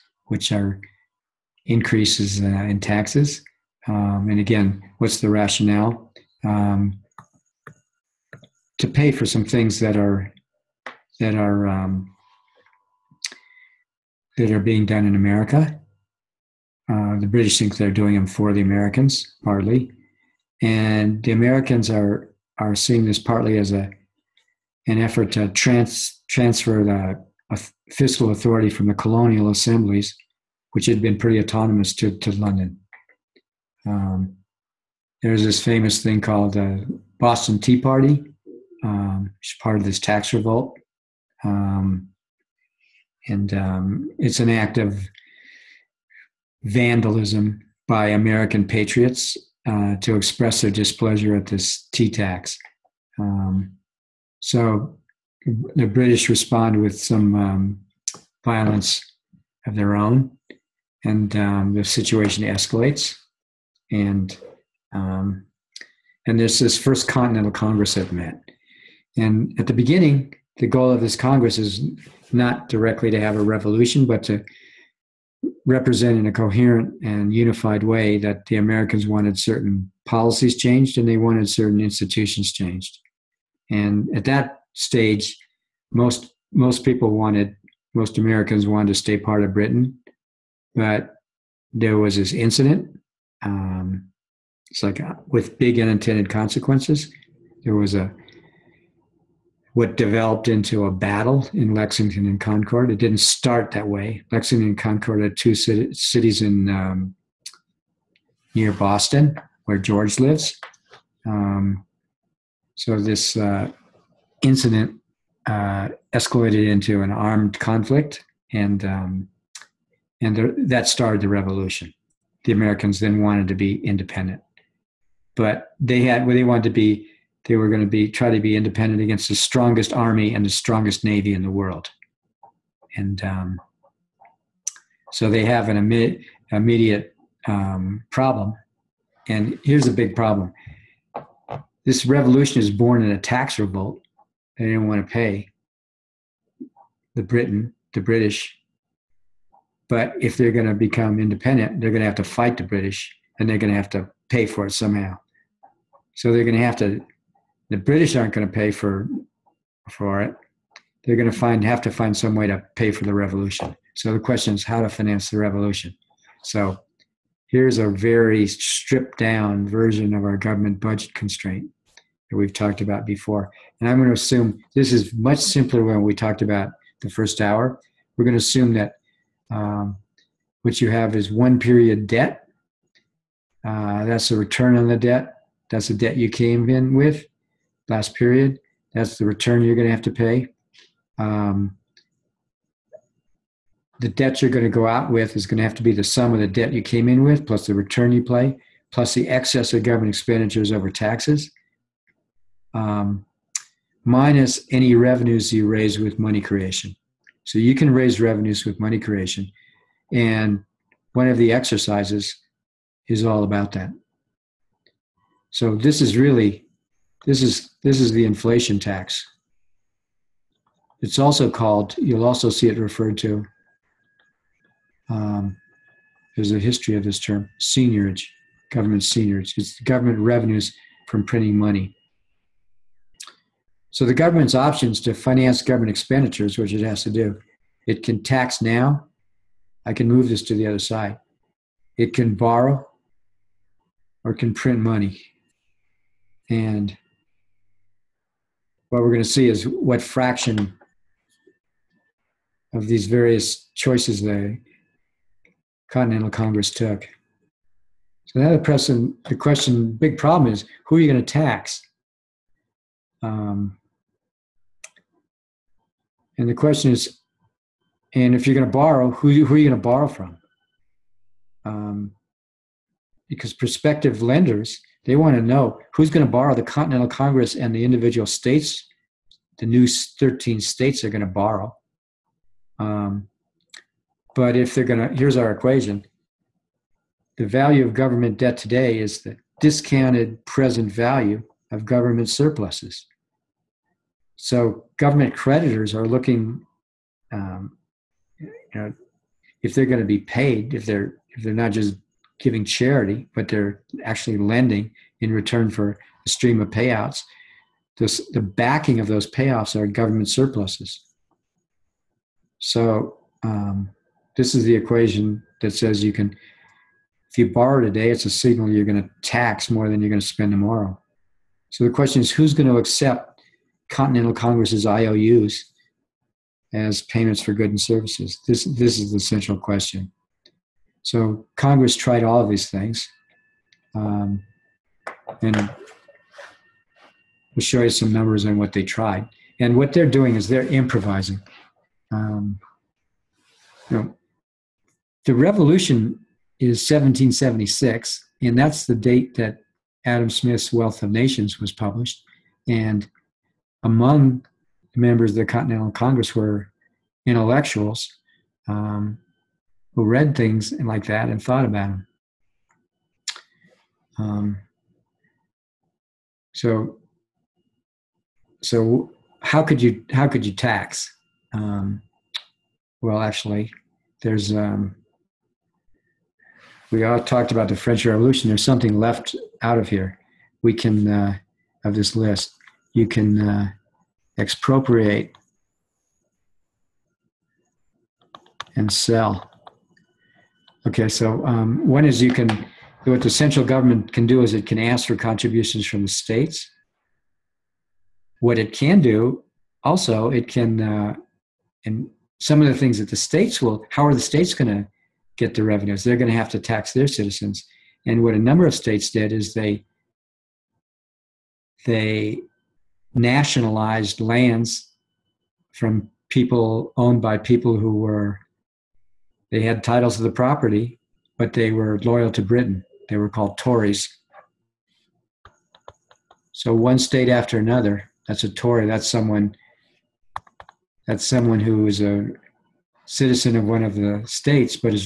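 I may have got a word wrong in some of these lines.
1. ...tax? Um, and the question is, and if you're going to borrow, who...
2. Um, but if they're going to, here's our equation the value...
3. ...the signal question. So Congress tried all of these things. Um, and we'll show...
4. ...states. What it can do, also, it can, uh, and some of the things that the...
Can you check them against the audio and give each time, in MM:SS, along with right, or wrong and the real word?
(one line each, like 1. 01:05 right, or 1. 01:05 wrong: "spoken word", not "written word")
1. 04:21 right
2. 04:42 right
3. 05:29 wrong: "central", not "signal"
4. 06:36 right.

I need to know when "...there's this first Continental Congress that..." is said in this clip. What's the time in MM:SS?
01:06.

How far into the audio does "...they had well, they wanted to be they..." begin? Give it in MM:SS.
02:05.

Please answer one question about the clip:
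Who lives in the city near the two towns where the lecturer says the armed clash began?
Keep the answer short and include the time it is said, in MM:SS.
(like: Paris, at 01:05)
George, at 01:49.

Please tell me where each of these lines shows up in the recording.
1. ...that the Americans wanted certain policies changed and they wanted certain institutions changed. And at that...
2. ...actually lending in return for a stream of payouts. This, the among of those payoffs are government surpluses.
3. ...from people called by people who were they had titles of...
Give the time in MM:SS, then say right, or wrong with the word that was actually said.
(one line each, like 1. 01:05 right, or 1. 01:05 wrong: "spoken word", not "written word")
1. 01:18 right
2. 05:04 wrong: "backing", not "among"
3. 06:55 wrong: "owned", not "called".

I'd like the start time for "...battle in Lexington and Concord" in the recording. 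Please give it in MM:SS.
01:40.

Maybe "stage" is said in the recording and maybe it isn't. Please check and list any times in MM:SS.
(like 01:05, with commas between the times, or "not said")
01:24.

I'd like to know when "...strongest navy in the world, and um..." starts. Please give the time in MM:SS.
02:10.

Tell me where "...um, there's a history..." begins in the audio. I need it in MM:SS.
03:45.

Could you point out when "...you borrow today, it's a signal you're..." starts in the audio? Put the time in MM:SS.
05:17.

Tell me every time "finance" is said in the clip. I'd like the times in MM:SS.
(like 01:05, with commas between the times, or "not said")
02:44, 03:55.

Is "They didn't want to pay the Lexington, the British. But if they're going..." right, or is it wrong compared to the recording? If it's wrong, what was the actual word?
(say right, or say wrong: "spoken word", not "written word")
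wrong: "Britain", not "Lexington".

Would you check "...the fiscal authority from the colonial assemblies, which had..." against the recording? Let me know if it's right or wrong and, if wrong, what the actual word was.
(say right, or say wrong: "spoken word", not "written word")
right.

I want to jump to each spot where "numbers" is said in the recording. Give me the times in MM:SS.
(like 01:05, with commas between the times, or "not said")
05:38, 06:48.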